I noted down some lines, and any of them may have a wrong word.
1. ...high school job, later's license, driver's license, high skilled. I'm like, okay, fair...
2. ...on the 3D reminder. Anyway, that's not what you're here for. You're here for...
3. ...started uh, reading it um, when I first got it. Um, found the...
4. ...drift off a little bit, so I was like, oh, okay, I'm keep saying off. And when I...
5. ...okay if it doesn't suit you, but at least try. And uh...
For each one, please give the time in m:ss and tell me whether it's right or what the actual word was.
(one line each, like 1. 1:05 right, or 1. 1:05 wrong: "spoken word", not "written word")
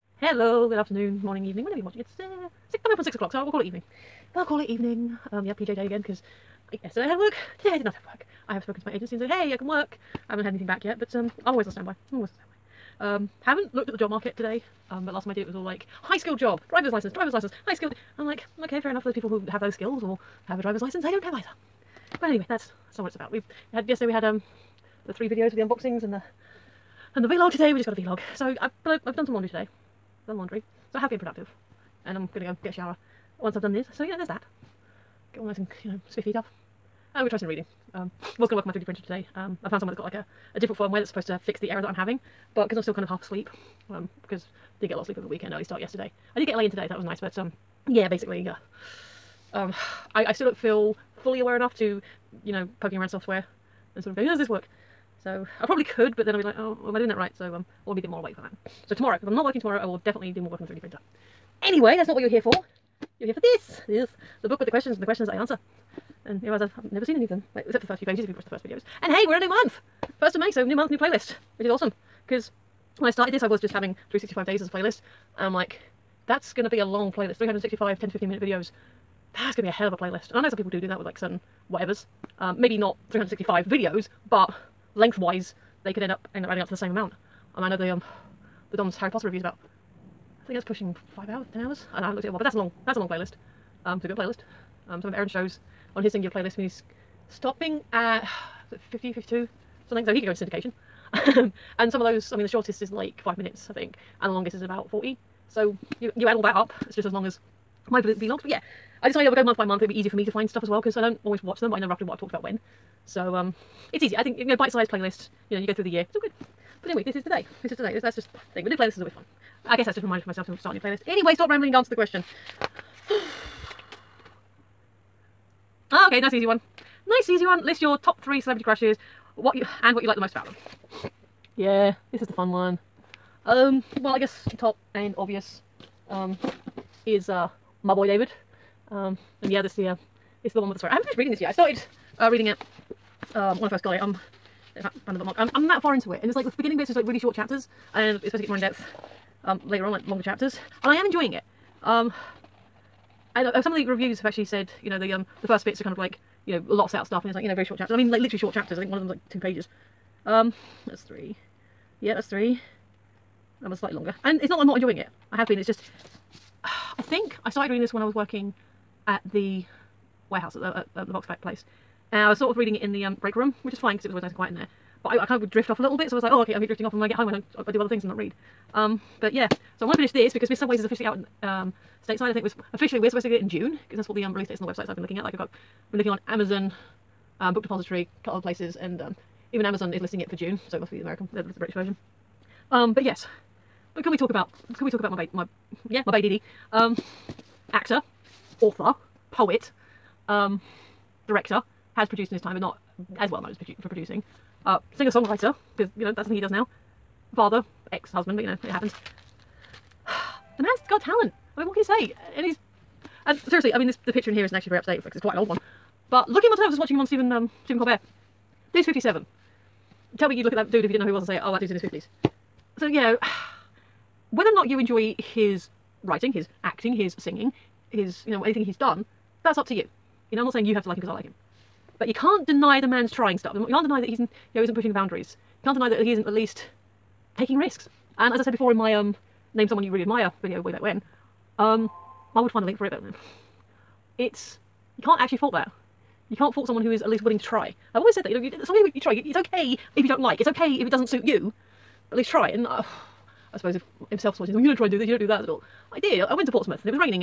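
1. 0:16 wrong: "driver", not "later"
2. 1:00 wrong: "printer", not "reminder"
3. 2:21 right
4. 2:55 wrong: "drifting", not "saying"
5. 4:10 right.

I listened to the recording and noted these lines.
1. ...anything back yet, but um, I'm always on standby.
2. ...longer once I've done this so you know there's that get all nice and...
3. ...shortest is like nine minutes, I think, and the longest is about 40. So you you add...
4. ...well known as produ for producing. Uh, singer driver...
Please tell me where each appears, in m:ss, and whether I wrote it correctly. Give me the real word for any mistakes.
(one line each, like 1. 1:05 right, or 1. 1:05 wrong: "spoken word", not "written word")
1. 0:10 right
2. 0:32 wrong: "shower", not "longer"
3. 1:42 wrong: "five", not "nine"
4. 3:23 wrong: "songwriter", not "driver".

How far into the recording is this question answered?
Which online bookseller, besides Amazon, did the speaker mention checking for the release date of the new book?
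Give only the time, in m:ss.
3:07.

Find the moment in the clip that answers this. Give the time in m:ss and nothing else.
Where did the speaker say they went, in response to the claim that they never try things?
4:16.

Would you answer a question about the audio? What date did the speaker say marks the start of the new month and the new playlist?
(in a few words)
1st of May.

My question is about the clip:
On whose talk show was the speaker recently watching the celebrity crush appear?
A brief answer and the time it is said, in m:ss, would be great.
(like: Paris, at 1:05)
Stephen Colbert, at 3:37.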